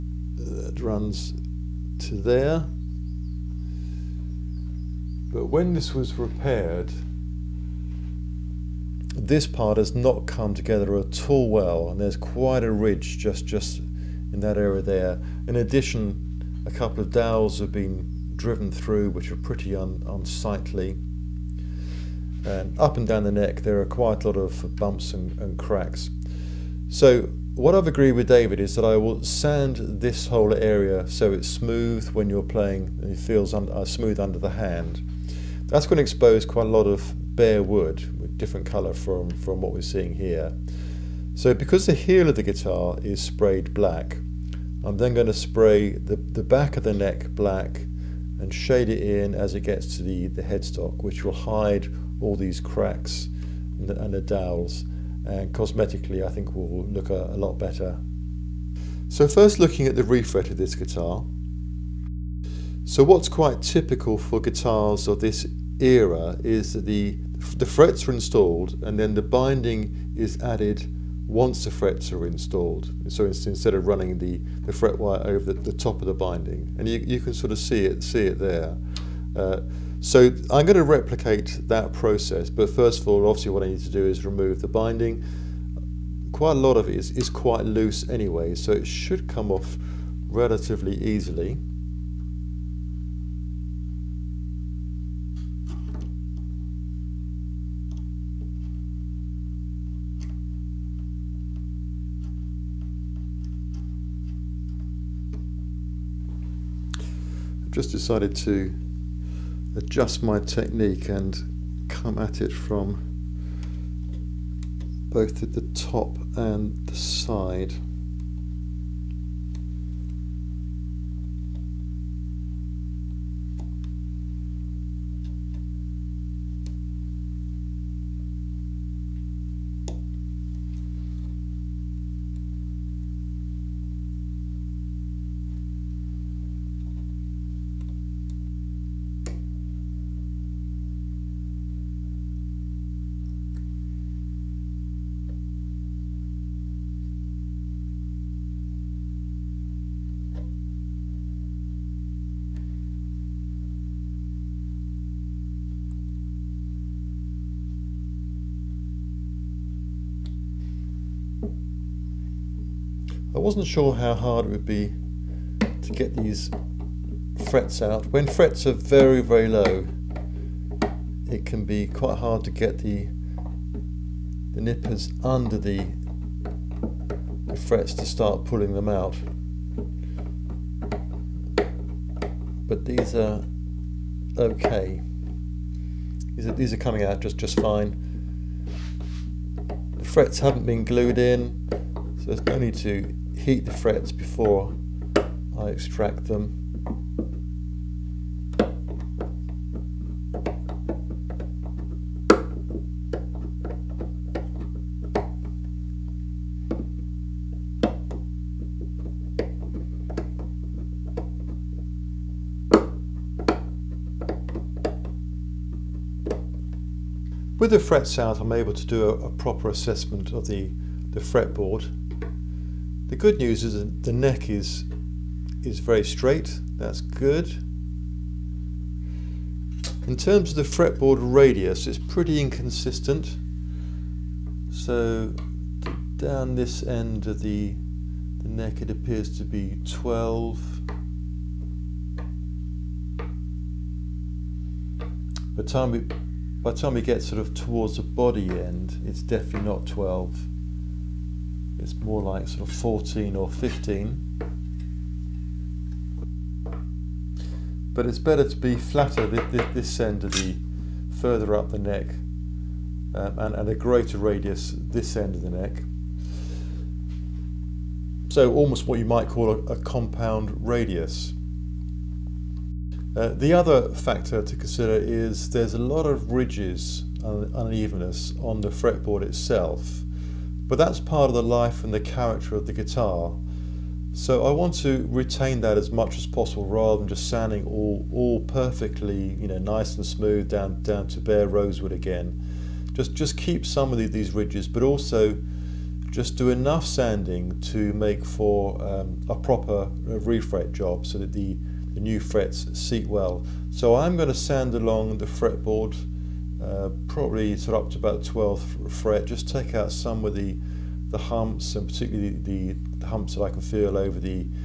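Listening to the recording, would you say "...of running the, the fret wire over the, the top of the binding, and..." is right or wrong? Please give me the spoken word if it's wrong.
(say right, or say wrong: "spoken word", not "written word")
right.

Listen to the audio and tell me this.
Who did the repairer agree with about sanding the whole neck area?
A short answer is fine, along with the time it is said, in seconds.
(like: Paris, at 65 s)
David, at 28 s.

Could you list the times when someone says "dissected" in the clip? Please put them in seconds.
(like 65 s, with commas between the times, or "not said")
not said.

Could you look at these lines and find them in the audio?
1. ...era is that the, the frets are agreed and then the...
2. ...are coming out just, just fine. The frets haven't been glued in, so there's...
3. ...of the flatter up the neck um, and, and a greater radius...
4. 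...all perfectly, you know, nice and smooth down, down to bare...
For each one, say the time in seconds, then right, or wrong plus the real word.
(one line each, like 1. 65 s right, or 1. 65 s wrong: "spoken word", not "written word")
1. 65 s wrong: "installed", not "agreed"
2. 186 s right
3. 260 s wrong: "further", not "flatter"
4. 288 s right.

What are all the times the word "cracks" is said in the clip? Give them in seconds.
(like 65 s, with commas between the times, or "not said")
25 s, 52 s.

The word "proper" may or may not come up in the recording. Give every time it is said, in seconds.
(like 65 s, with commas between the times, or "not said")
219 s, 299 s.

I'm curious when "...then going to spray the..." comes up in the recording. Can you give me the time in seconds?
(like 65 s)
44 s.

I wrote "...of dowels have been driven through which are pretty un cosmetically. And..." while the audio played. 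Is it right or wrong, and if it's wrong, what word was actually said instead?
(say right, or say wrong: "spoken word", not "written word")
wrong: "unsightly", not "cosmetically".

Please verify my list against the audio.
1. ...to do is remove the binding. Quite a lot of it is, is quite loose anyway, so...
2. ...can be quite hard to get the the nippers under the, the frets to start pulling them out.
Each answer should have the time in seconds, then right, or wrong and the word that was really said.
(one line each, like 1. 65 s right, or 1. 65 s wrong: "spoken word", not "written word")
1. 83 s right
2. 171 s right.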